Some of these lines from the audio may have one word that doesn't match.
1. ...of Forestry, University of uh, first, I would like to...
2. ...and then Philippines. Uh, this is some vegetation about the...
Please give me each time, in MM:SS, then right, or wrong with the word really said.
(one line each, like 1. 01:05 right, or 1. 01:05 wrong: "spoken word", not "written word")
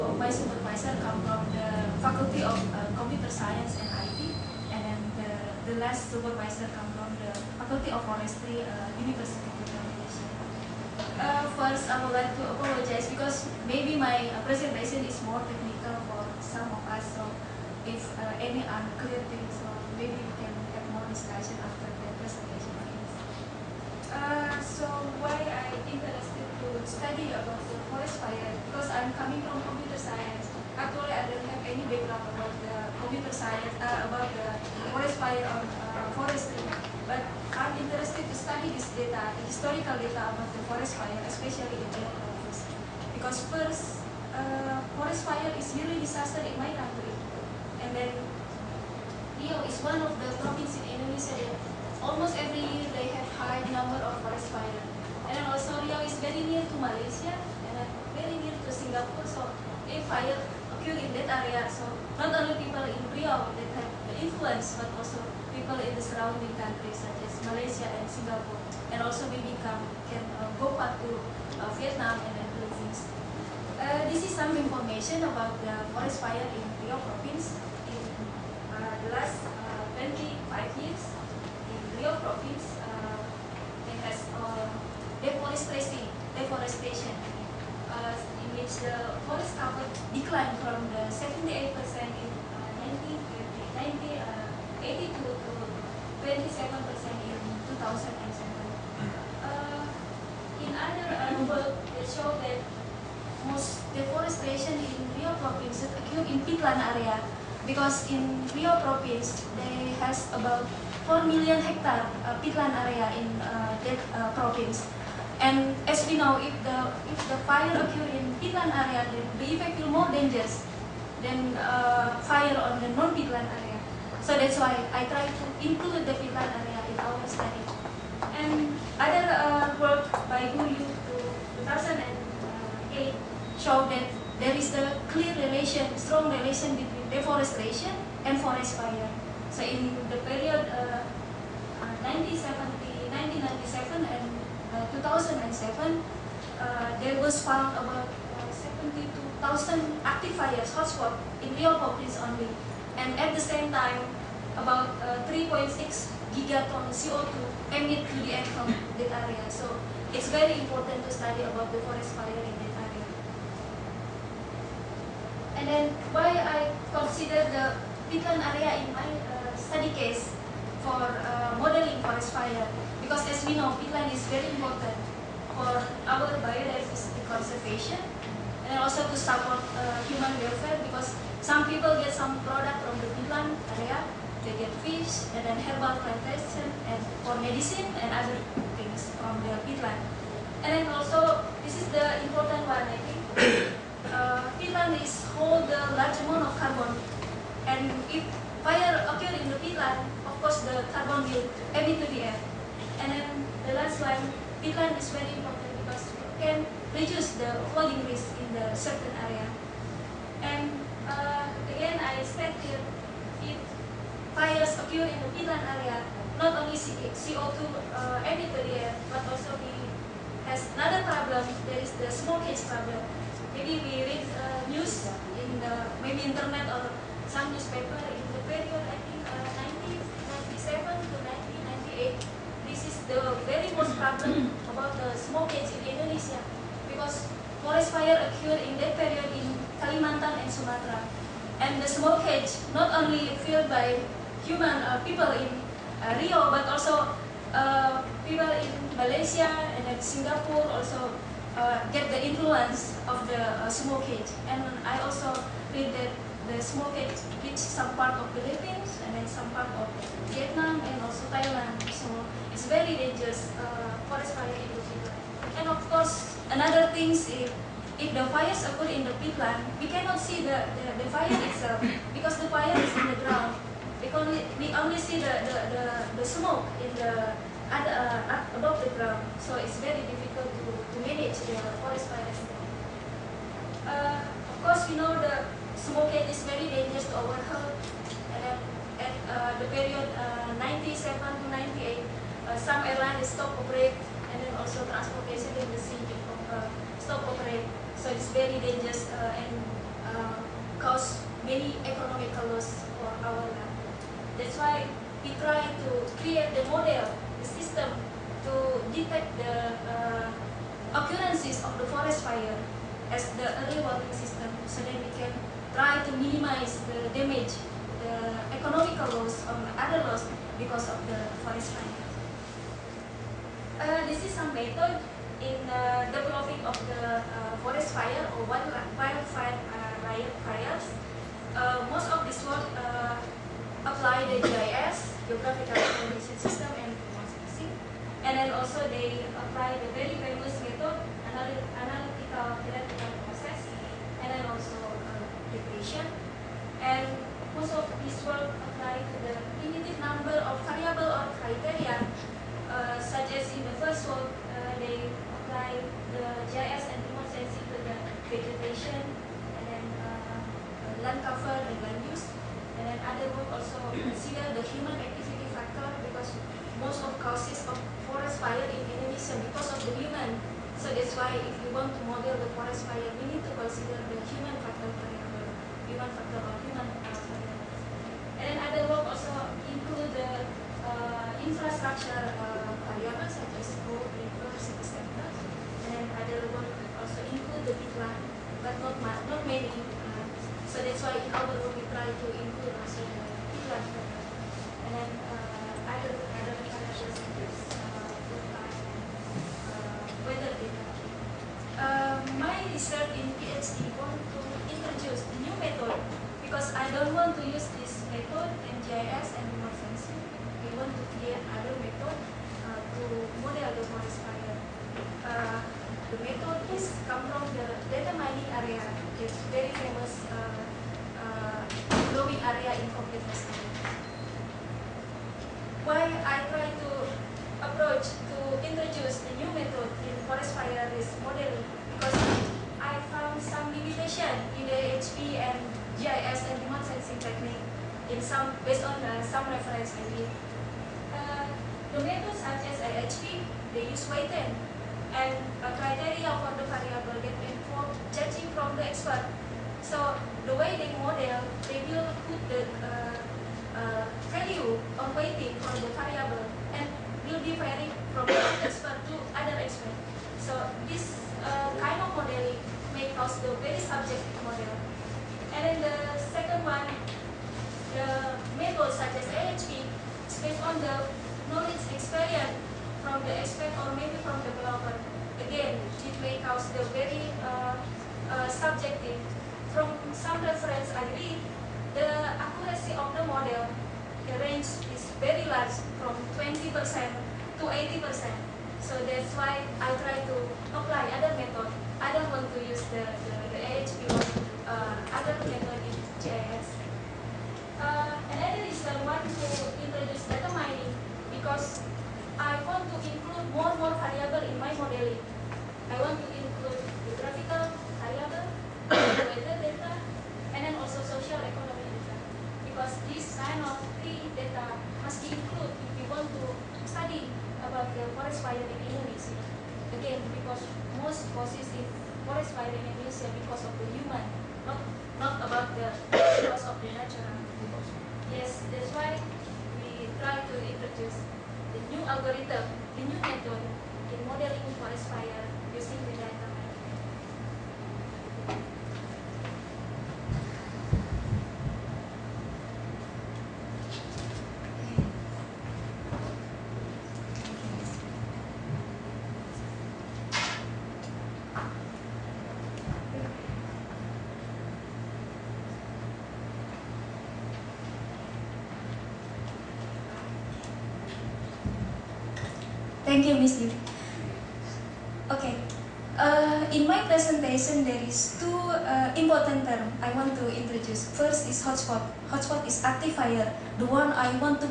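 1. 00:07 right
2. 01:12 wrong: "information", not "vegetation".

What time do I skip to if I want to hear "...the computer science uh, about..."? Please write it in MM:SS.
00:32.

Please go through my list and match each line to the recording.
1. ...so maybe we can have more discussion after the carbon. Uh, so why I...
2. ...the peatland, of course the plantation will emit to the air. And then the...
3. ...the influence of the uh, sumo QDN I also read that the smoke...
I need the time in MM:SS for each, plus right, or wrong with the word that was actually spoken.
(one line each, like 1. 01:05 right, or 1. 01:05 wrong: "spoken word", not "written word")
1. 00:19 wrong: "presentation", not "carbon"
2. 03:19 wrong: "carbon", not "plantation"
3. 04:12 wrong: "And", not "QDN".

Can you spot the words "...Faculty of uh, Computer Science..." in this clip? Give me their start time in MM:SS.
00:02.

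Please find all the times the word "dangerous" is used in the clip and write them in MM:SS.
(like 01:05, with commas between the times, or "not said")
02:00, 04:22, 04:46, 04:58.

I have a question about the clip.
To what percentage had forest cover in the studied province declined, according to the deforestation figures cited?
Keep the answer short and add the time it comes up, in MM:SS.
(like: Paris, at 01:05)
27%, at 01:36.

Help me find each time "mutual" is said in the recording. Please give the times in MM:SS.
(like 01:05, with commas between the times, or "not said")
not said.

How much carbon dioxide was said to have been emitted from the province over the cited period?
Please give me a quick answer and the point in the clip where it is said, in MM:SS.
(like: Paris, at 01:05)
3.6 gigatons, at 02:35.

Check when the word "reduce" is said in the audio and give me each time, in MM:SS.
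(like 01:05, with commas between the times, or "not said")
03:26.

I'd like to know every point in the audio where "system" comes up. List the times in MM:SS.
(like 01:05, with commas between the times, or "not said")
05:07, 05:14, 05:36.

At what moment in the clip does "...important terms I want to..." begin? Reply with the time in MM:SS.
09:29.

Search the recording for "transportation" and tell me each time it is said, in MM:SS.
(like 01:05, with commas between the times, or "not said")
04:54.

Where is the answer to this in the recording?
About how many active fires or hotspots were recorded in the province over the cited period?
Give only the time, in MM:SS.
02:29.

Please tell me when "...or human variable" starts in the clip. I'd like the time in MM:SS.
06:16.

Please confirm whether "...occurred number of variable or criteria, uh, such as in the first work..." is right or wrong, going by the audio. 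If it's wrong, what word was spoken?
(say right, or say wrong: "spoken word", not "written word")
wrong: "limited", not "occurred".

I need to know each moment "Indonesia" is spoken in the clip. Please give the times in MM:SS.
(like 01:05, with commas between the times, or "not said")
00:51, 03:55, 06:08.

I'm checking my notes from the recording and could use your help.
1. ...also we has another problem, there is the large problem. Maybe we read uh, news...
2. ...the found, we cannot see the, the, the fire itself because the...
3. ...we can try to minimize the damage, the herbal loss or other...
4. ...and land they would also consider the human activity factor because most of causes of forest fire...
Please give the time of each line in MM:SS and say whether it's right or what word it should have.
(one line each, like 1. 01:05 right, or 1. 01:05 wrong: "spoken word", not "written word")
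1. 03:39 wrong: "smokage", not "large"
2. 04:29 wrong: "peatland", not "found"
3. 05:14 wrong: "economical", not "herbal"
4. 06:01 right.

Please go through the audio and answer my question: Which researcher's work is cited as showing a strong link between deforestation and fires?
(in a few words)
Uryu.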